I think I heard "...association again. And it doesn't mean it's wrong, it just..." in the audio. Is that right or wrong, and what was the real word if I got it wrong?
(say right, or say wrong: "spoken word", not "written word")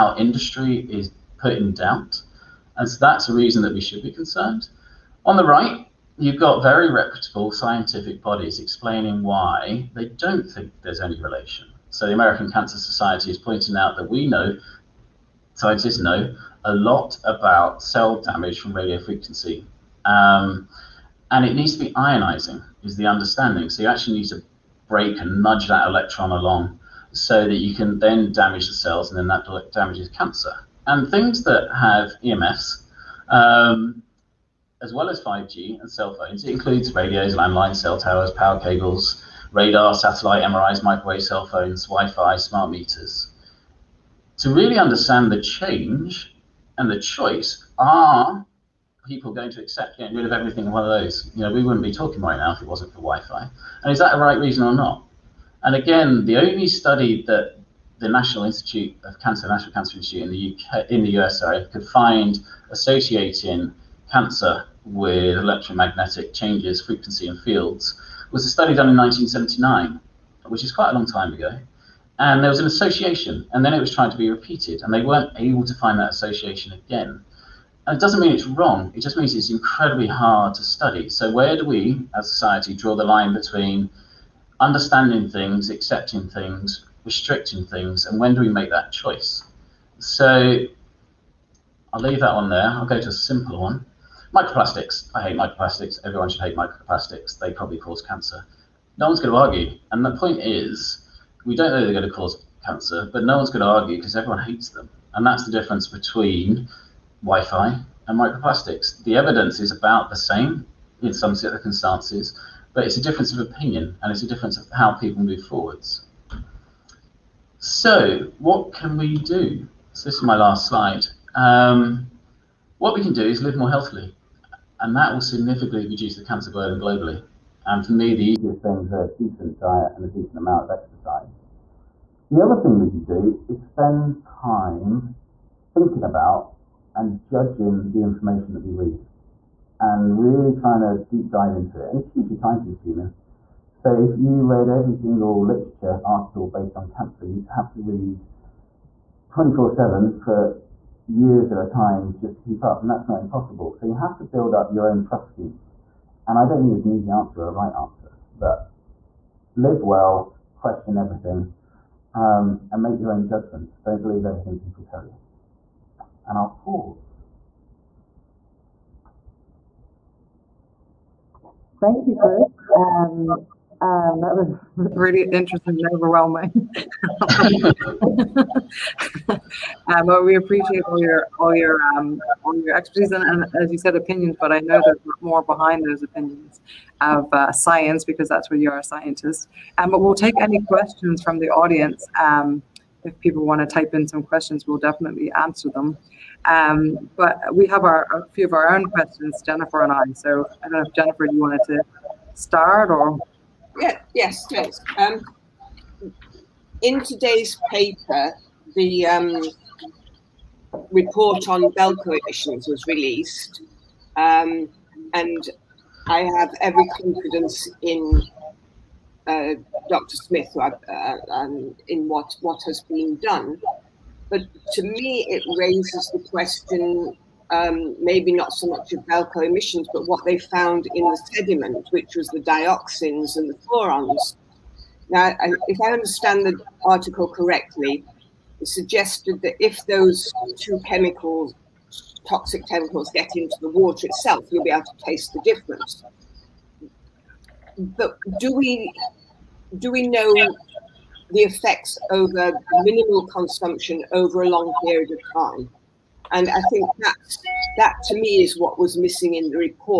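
right.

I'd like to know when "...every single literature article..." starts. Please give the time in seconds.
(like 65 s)
144 s.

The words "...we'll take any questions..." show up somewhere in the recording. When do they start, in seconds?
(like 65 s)
189 s.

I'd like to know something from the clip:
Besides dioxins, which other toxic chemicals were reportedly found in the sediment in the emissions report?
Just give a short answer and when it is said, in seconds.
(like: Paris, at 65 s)
Furans, at 233 s.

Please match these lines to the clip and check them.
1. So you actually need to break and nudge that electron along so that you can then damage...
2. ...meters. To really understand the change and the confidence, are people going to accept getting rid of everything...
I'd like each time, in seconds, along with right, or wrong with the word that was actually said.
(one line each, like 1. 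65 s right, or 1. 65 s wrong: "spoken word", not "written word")
1. 23 s right
2. 42 s wrong: "choice", not "confidence".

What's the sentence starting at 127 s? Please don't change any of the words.
And for me, the easiest things are a decent diet and a decent amount of exercise.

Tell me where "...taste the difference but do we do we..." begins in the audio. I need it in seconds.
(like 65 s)
245 s.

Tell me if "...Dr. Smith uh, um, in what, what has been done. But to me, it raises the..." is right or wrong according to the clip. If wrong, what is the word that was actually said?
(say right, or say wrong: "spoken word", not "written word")
right.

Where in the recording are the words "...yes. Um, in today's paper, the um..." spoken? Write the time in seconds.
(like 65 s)
204 s.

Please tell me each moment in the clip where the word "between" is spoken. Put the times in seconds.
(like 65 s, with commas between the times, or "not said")
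83 s, 105 s.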